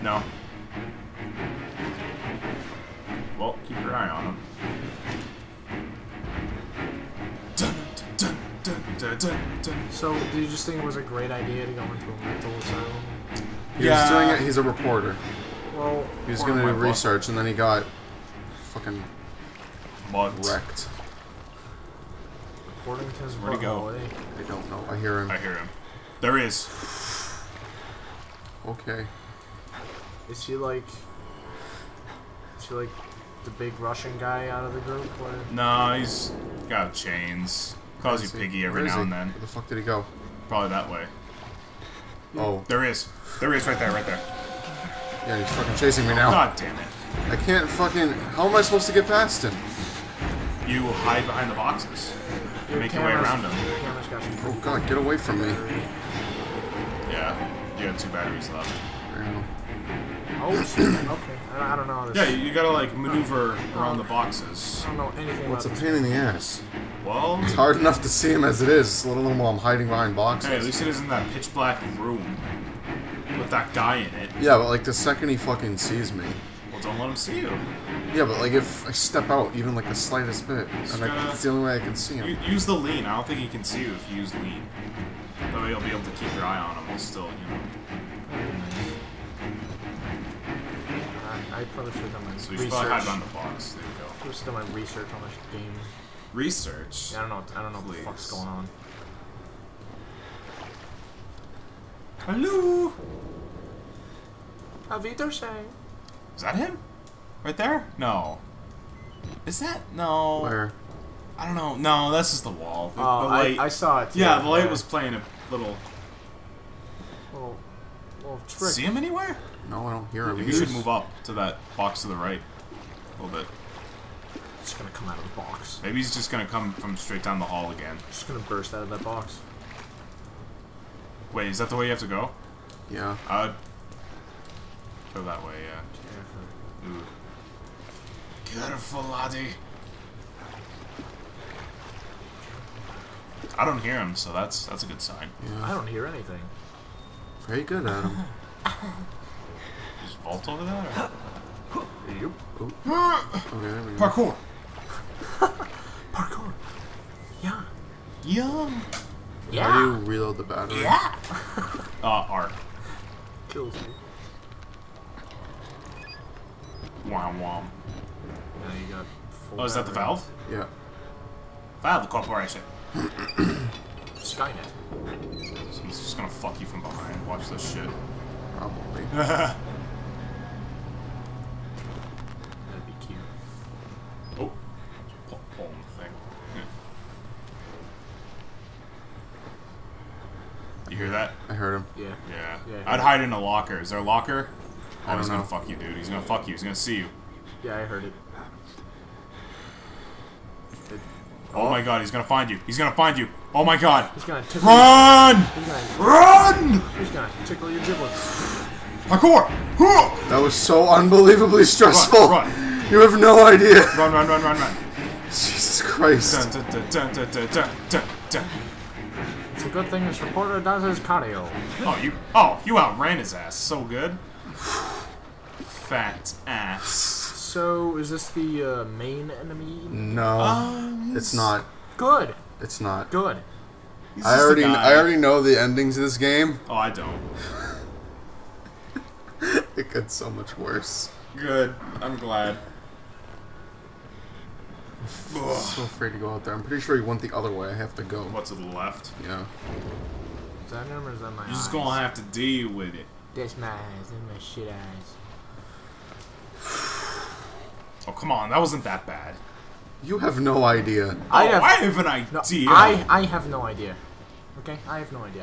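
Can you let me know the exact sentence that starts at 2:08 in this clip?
Just gonna burst out of that box.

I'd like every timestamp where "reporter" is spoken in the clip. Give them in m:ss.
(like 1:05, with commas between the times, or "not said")
0:14, 3:40.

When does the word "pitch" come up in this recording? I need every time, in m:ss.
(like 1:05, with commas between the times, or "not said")
1:11.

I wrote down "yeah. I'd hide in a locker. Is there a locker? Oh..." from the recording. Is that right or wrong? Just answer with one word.
right.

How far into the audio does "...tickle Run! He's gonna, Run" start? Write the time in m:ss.
3:24.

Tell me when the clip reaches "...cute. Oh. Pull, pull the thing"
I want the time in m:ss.
3:03.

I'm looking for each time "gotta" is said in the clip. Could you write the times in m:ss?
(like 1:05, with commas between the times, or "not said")
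1:02, 1:21.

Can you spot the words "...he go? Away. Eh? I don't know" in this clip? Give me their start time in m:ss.
0:23.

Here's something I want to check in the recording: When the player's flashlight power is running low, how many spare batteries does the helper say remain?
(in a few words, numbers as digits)
2.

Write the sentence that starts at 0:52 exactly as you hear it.
Your make your way around them.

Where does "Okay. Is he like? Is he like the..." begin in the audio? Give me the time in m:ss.
0:28.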